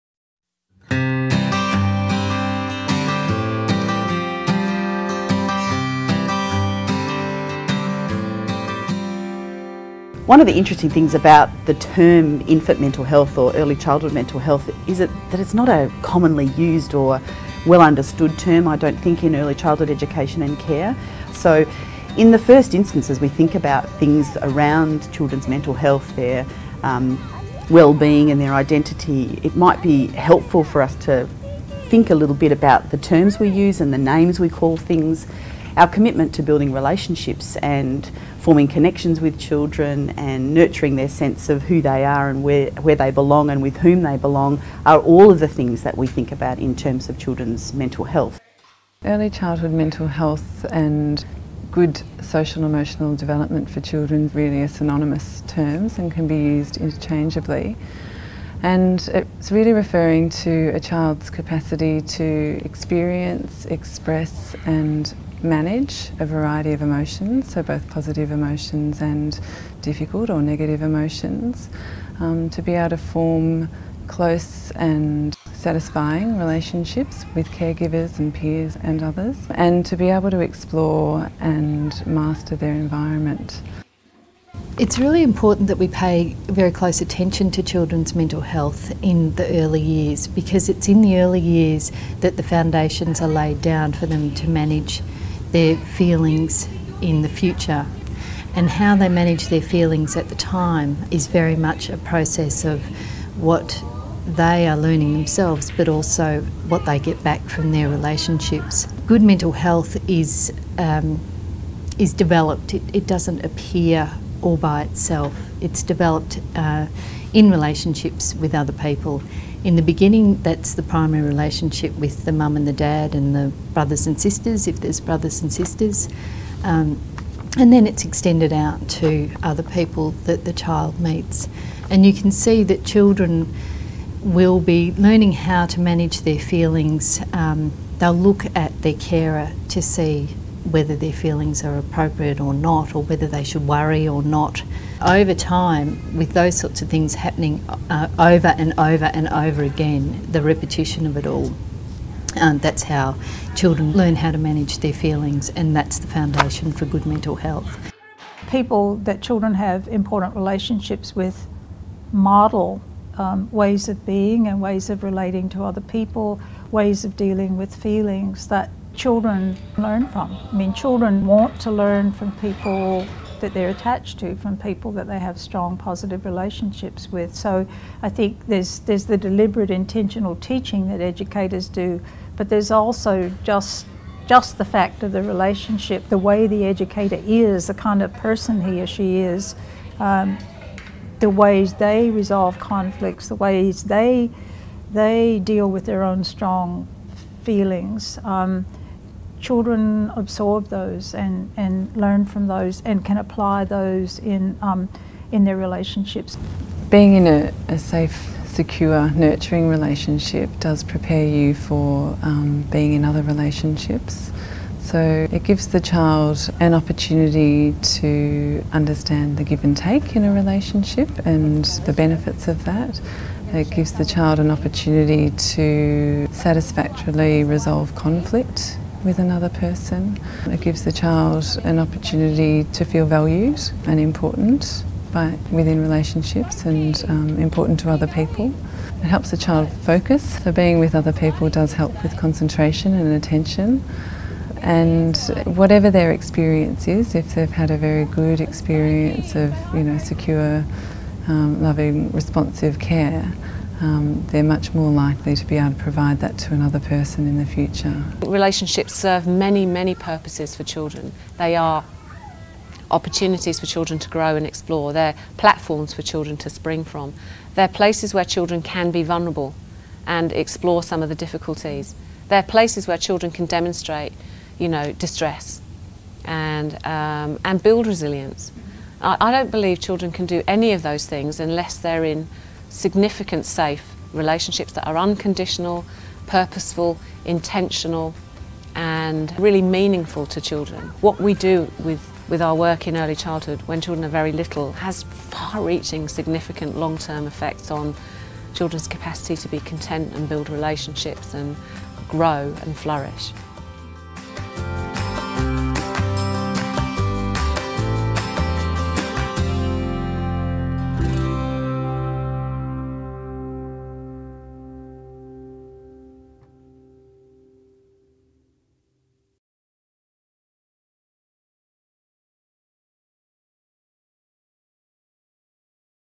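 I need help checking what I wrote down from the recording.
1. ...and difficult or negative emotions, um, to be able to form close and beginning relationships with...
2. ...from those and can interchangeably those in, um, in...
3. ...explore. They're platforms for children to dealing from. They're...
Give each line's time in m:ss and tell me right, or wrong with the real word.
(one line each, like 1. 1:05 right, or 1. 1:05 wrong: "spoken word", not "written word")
1. 1:09 wrong: "satisfying", not "beginning"
2. 3:22 wrong: "apply", not "interchangeably"
3. 4:24 wrong: "spring", not "dealing".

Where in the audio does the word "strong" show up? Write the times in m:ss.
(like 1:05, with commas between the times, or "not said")
2:55, 3:16.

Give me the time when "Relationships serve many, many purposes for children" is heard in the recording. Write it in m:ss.
4:18.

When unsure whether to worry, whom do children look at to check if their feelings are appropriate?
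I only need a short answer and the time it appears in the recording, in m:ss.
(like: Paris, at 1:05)
their carer, at 2:18.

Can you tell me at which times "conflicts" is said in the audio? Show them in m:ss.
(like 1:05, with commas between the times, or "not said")
3:12, 3:47.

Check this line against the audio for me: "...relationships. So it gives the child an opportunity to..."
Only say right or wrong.
right.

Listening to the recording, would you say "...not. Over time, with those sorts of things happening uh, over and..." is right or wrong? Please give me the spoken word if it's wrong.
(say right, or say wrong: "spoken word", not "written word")
right.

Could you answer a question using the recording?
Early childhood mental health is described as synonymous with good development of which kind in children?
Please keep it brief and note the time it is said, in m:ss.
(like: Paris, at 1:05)
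social and emotional, at 0:52.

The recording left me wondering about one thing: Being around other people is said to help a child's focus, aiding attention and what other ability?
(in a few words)
concentration.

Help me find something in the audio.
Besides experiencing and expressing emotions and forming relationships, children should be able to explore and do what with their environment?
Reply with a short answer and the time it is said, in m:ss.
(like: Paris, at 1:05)
master, at 1:22.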